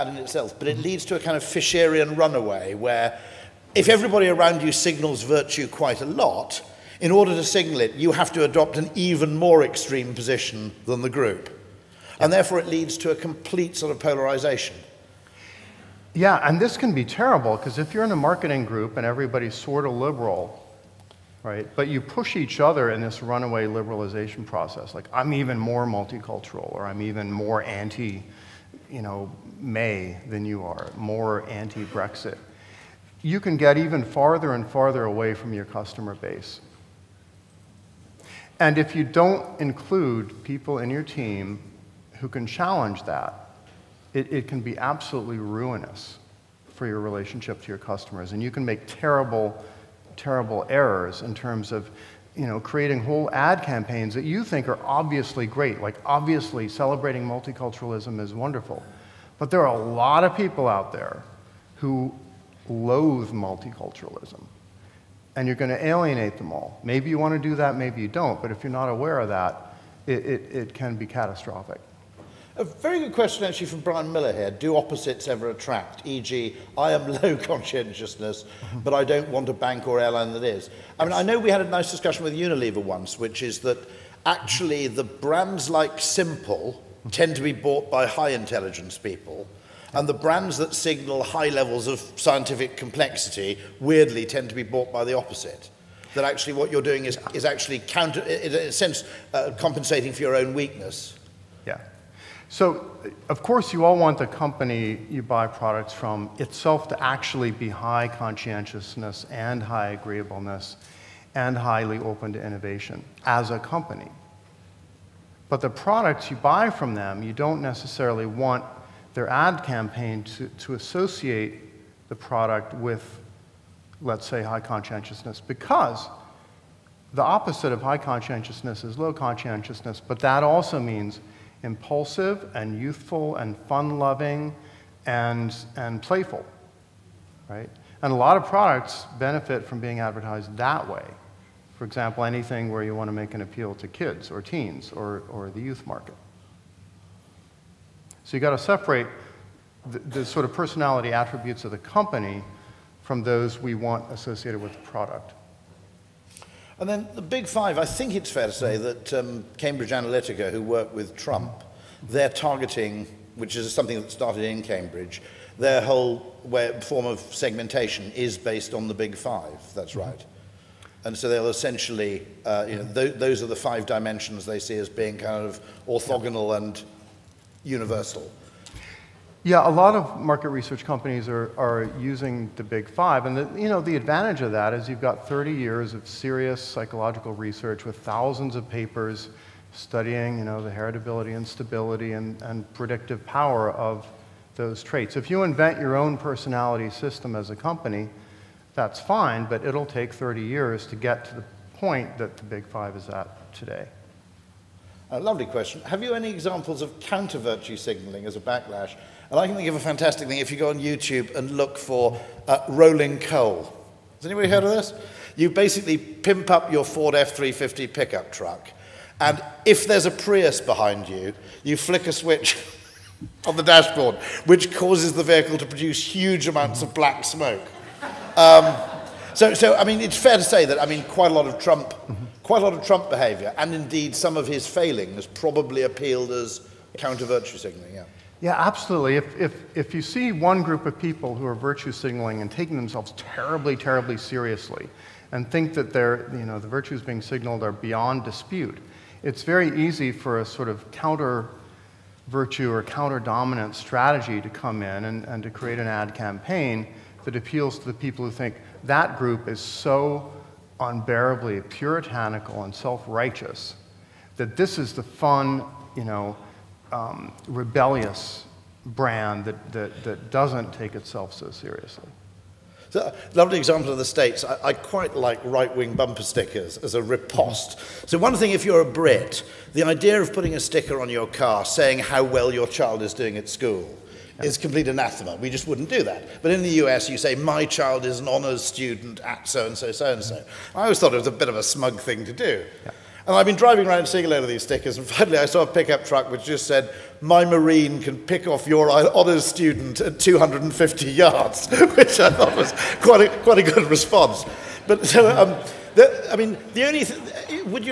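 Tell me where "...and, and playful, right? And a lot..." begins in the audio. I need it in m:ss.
2:15.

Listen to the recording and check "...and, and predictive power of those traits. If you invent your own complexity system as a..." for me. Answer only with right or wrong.
wrong.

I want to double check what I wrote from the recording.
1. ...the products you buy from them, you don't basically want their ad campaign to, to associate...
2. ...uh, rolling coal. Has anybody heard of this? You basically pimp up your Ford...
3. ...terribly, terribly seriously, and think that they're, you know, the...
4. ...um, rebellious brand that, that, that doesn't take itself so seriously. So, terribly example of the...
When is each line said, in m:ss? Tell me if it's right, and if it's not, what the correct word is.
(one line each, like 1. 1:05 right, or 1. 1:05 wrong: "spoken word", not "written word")
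1. 1:55 wrong: "necessarily", not "basically"
2. 3:32 right
3. 4:03 right
4. 4:26 wrong: "lovely", not "terribly".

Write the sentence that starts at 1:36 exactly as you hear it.
That actually what you're doing is, is actually counter, in a sense, uh, compensating for your own weakness.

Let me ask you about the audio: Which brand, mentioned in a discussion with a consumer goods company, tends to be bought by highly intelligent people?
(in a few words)
Simple.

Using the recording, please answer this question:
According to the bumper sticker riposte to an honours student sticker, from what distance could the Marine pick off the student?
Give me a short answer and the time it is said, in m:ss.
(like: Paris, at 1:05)
250 yards, at 5:00.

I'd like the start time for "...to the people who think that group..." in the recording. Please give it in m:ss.
4:17.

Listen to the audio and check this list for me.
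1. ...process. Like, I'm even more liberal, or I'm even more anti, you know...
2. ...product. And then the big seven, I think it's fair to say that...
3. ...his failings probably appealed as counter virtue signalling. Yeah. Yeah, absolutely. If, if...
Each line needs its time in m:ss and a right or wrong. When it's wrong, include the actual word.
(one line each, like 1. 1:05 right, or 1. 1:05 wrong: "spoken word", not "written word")
1. 0:24 wrong: "multicultural", not "liberal"
2. 2:34 wrong: "five", not "seven"
3. 3:54 right.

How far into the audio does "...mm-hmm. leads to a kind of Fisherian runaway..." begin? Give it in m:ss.
0:00.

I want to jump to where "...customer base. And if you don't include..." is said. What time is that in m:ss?
0:35.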